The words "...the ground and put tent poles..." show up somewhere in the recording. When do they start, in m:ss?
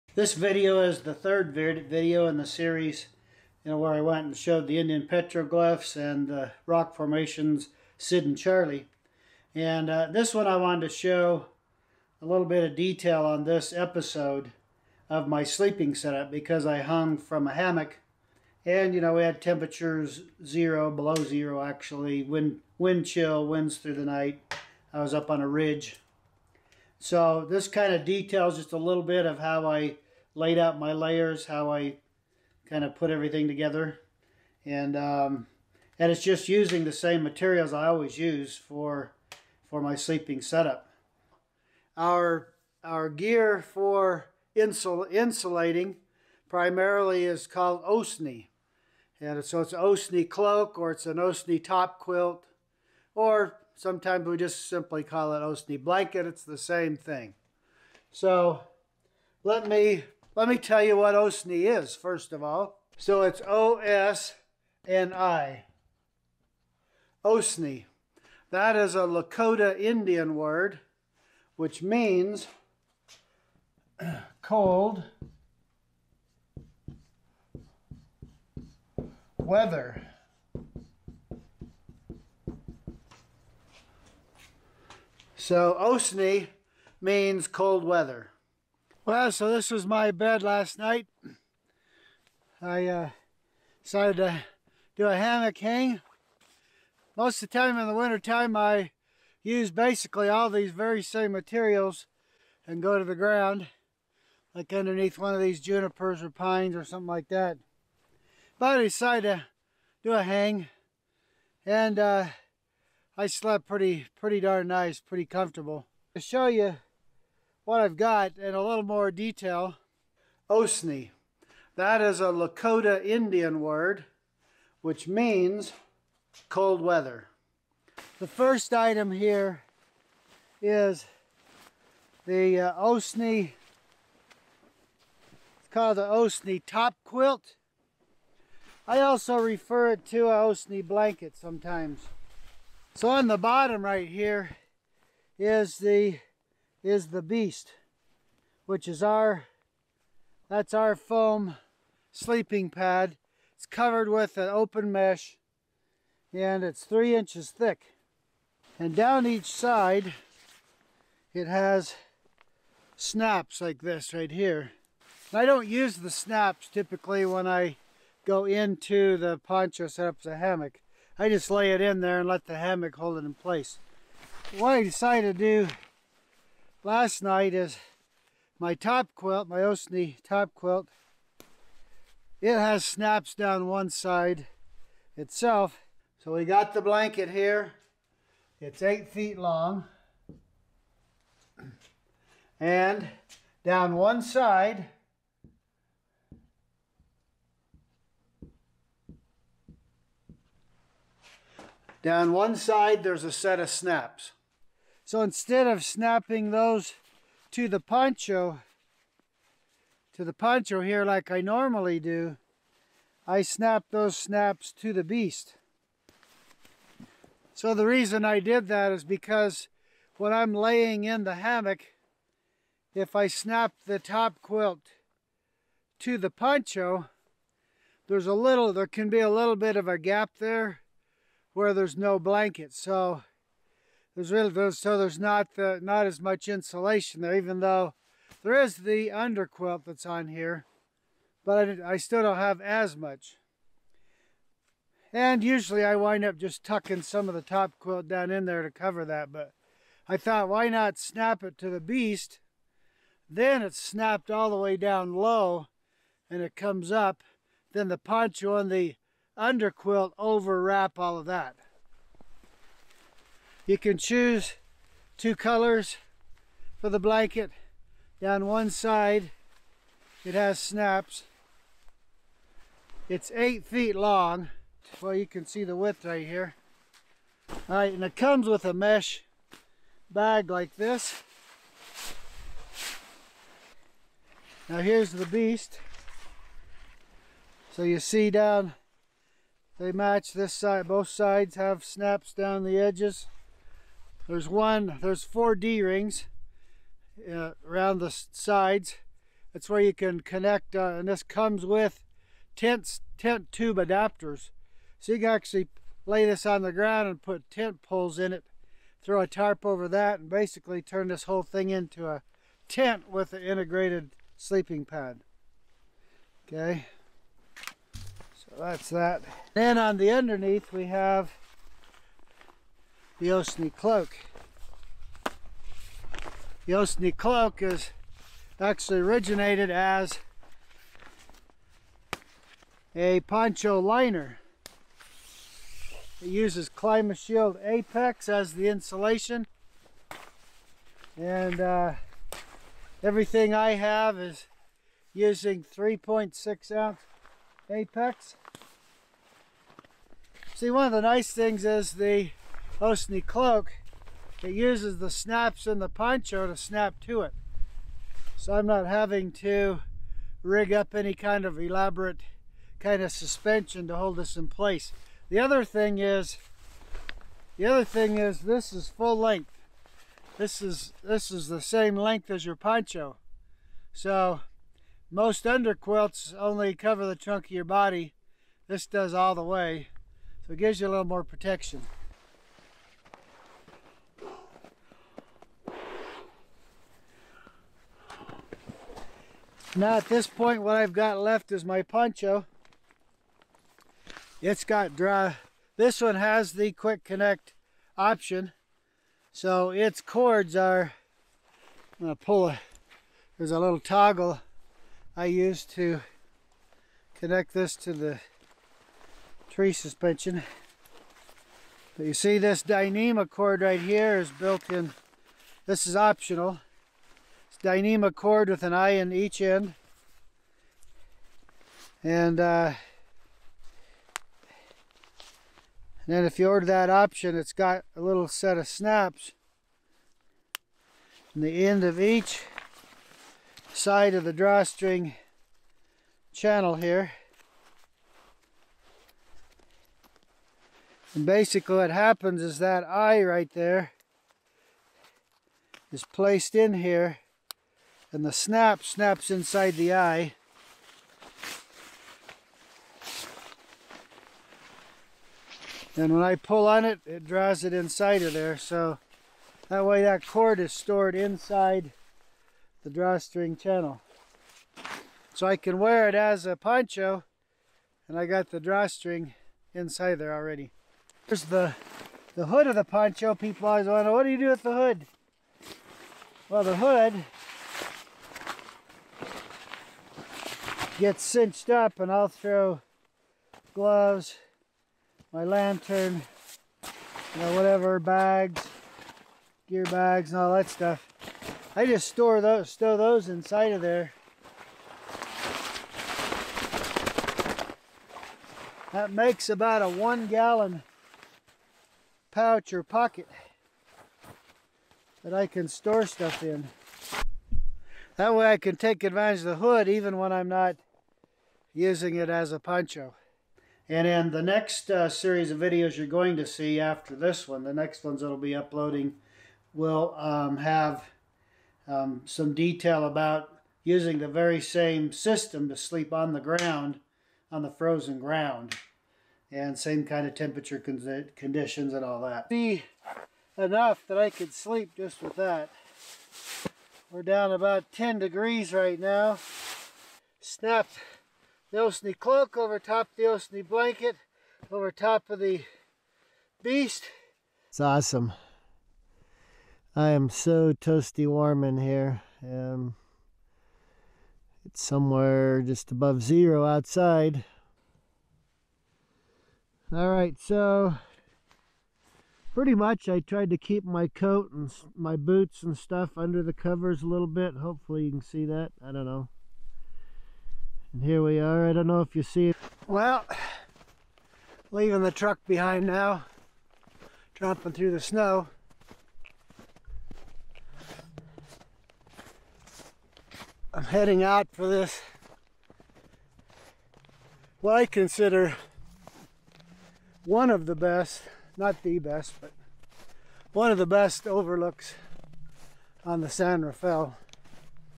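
5:06.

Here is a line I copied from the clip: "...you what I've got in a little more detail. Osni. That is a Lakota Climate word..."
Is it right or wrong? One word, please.
wrong.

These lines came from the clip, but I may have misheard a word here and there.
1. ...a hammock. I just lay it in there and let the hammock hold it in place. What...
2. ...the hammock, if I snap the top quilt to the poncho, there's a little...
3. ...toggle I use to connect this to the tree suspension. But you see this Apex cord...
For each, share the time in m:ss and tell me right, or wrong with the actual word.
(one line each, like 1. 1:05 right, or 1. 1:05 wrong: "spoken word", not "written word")
1. 2:50 right
2. 3:41 right
3. 6:43 wrong: "Dyneema", not "Apex".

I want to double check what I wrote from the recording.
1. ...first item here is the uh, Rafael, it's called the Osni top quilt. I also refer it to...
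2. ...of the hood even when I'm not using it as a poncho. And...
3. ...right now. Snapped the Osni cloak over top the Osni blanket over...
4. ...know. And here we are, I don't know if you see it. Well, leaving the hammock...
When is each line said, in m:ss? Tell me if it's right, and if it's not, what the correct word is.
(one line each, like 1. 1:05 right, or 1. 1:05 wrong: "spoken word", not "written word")
1. 2:08 wrong: "Osni", not "Rafael"
2. 8:29 right
3. 8:58 right
4. 9:29 wrong: "truck", not "hammock".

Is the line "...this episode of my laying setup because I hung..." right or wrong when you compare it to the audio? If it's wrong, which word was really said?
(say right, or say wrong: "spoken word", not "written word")
wrong: "sleeping", not "laying".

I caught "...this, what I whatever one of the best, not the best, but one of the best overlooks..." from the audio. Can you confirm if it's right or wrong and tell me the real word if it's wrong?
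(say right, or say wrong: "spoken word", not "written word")
wrong: "consider", not "whatever".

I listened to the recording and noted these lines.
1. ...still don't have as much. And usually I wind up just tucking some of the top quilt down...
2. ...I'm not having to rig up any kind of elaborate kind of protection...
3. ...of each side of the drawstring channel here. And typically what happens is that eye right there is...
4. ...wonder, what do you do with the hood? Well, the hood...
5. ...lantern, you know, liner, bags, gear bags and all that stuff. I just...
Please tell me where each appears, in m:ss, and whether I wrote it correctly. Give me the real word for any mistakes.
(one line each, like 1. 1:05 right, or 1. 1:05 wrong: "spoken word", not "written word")
1. 4:01 right
2. 5:58 wrong: "suspension", not "protection"
3. 7:11 wrong: "basically", not "typically"
4. 7:53 right
5. 8:05 wrong: "whatever", not "liner".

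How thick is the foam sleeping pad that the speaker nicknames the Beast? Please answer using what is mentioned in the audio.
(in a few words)
3 inches.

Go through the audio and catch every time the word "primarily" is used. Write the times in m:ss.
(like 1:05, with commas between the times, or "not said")
0:46.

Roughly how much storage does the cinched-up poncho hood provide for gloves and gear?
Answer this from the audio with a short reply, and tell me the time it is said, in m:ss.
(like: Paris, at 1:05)
one gallon, at 8:19.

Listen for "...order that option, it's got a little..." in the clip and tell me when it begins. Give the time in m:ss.
7:06.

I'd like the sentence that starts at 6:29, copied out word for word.
Now at this point, what I've got left is my poncho.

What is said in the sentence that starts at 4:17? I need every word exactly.
Then the poncho and the underquilt overwrap all of that.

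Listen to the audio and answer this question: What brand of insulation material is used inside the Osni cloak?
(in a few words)
Climate Shield Apex.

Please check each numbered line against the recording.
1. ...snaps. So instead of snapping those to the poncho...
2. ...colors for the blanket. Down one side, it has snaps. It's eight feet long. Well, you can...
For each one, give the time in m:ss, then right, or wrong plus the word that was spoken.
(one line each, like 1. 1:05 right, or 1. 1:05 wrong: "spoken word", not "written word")
1. 3:23 right
2. 4:25 right.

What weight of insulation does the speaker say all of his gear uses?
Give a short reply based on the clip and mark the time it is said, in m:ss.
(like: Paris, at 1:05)
3.6 ounce, at 5:45.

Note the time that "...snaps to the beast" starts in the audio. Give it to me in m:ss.
3:34.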